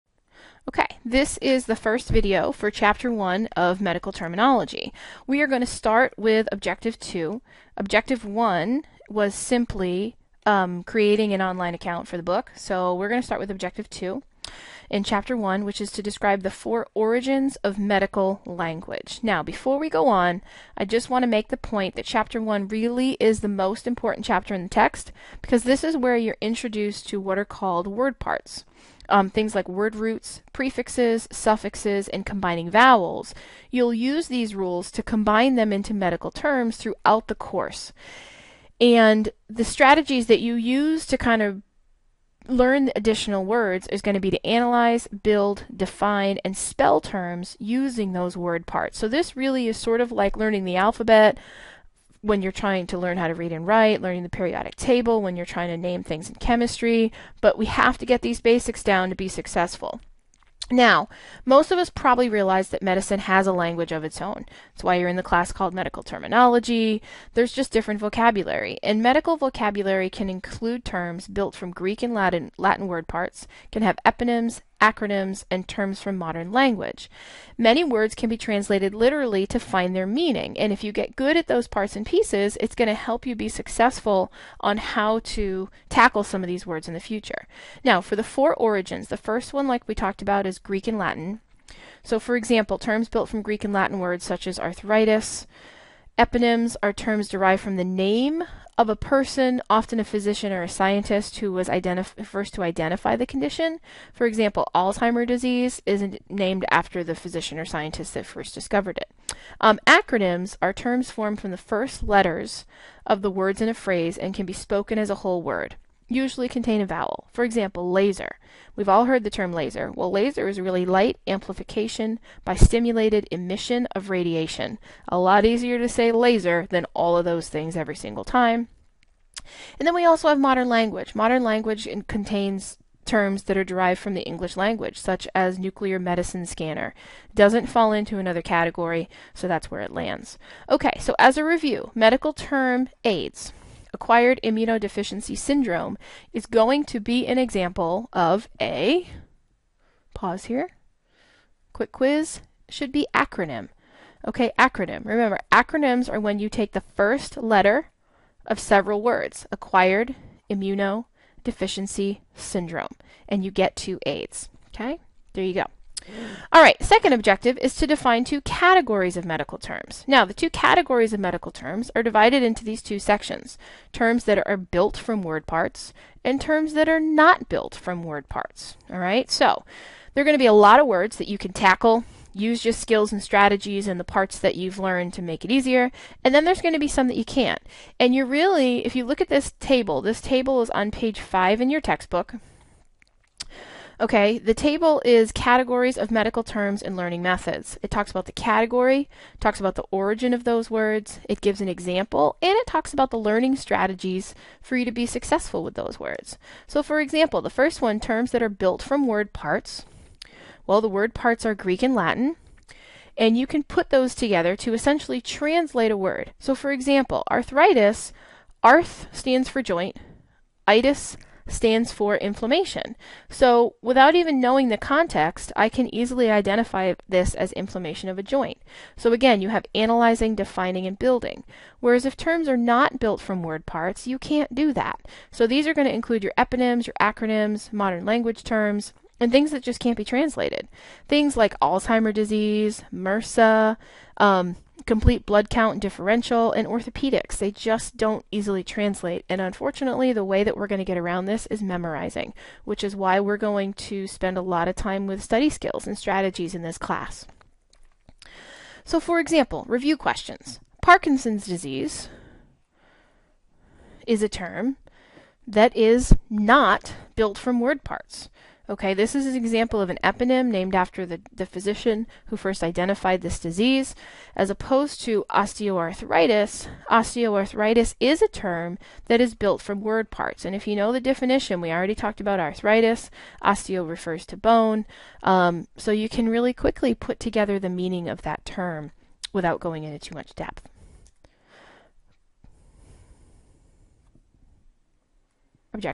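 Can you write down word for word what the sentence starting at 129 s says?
And then we also have modern language.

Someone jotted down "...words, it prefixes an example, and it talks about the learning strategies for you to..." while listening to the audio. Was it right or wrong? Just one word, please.
wrong.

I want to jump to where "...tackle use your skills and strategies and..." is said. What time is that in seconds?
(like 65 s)
181 s.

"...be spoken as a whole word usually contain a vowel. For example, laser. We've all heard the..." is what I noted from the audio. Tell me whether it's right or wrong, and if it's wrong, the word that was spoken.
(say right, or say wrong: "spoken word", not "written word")
right.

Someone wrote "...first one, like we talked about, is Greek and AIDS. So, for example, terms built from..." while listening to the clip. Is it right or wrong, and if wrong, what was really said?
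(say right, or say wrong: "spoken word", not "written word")
wrong: "Latin", not "AIDS".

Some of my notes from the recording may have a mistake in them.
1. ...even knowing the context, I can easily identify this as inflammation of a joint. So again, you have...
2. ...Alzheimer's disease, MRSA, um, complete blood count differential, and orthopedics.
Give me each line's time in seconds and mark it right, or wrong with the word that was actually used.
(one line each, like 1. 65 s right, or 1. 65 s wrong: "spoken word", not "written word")
1. 224 s right
2. 241 s right.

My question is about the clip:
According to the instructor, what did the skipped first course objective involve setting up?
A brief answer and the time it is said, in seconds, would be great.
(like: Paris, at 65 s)
an online account for the book, at 10 s.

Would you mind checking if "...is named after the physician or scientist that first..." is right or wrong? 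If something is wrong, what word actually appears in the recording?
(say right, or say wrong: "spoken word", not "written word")
right.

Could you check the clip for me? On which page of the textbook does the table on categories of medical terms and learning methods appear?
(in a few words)
5.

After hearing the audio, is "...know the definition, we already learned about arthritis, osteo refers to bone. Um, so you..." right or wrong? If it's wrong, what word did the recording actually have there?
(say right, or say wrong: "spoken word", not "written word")
wrong: "talked", not "learned".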